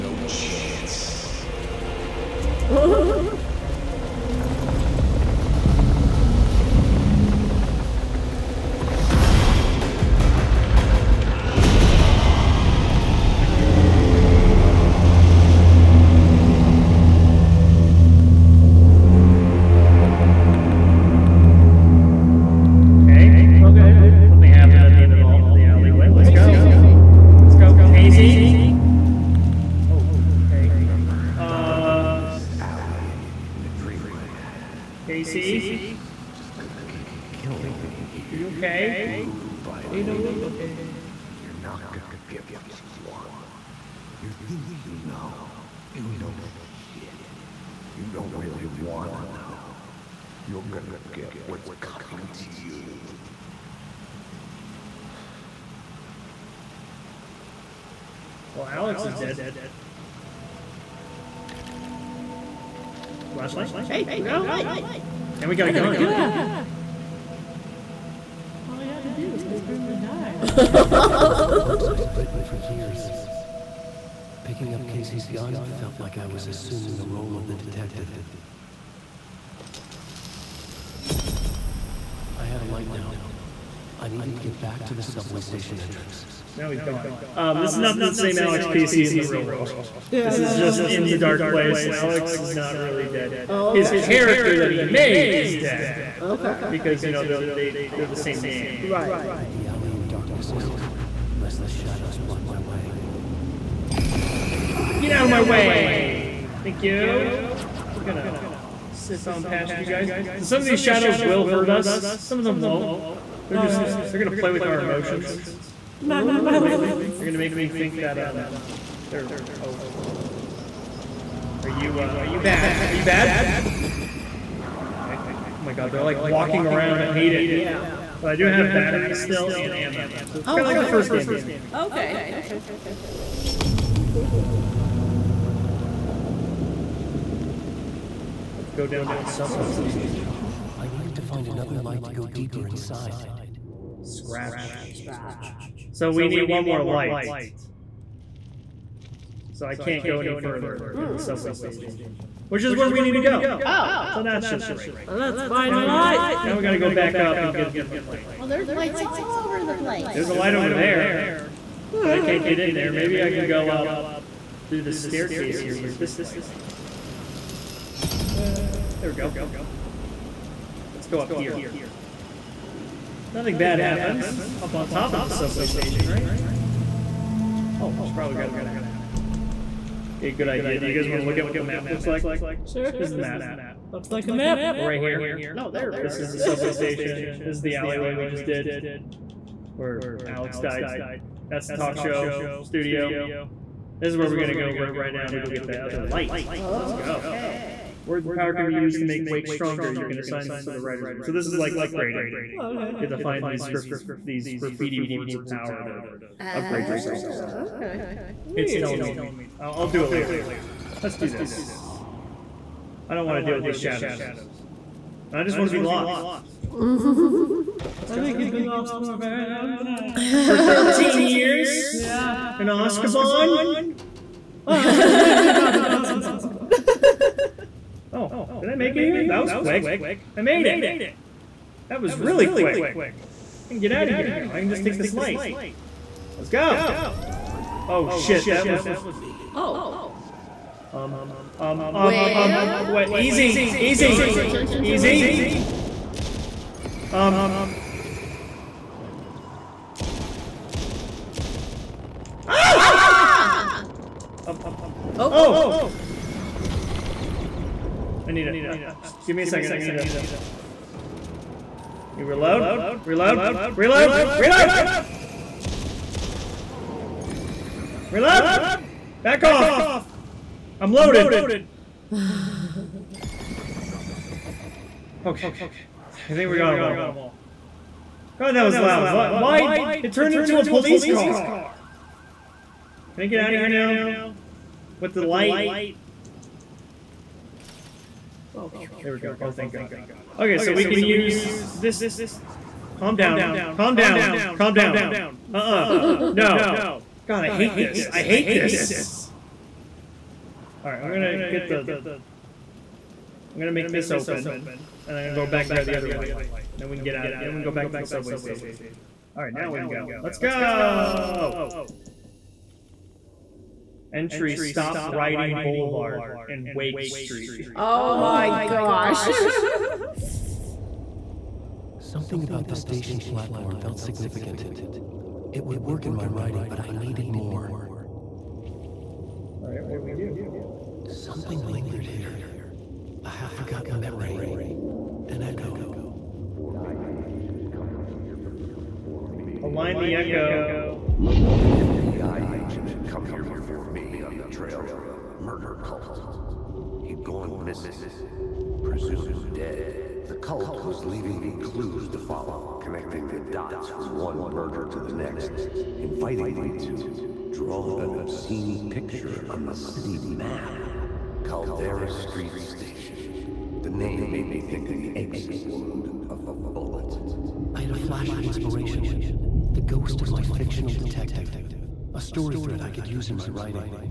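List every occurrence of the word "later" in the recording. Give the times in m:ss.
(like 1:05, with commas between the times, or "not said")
3:30.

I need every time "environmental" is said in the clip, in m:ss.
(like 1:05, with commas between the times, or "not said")
not said.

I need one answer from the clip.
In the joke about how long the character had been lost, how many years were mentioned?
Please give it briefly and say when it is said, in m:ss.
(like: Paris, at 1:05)
13, at 3:40.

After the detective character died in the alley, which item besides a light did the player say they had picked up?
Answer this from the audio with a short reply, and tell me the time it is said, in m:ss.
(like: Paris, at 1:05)
a gun, at 1:05.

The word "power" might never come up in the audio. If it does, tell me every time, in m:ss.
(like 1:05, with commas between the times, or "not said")
3:18, 3:25.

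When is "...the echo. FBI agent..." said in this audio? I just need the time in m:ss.
5:39.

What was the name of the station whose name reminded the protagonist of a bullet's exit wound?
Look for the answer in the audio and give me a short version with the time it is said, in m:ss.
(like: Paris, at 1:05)
Caldera Street Station, at 6:01.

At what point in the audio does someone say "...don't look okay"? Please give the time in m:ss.
0:40.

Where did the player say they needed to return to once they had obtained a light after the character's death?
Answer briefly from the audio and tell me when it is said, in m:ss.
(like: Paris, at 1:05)
subway station entrance, at 1:25.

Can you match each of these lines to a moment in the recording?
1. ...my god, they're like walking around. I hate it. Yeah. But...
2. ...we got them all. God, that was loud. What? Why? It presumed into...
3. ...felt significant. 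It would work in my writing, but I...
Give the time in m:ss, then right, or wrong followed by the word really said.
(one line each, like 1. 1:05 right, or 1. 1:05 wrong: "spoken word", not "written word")
1. 2:05 right
2. 4:36 wrong: "turned", not "presumed"
3. 5:23 right.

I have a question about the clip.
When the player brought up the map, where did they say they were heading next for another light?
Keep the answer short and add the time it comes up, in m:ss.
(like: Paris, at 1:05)
talk show studio, at 3:11.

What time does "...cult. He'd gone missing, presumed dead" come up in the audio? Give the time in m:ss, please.
5:45.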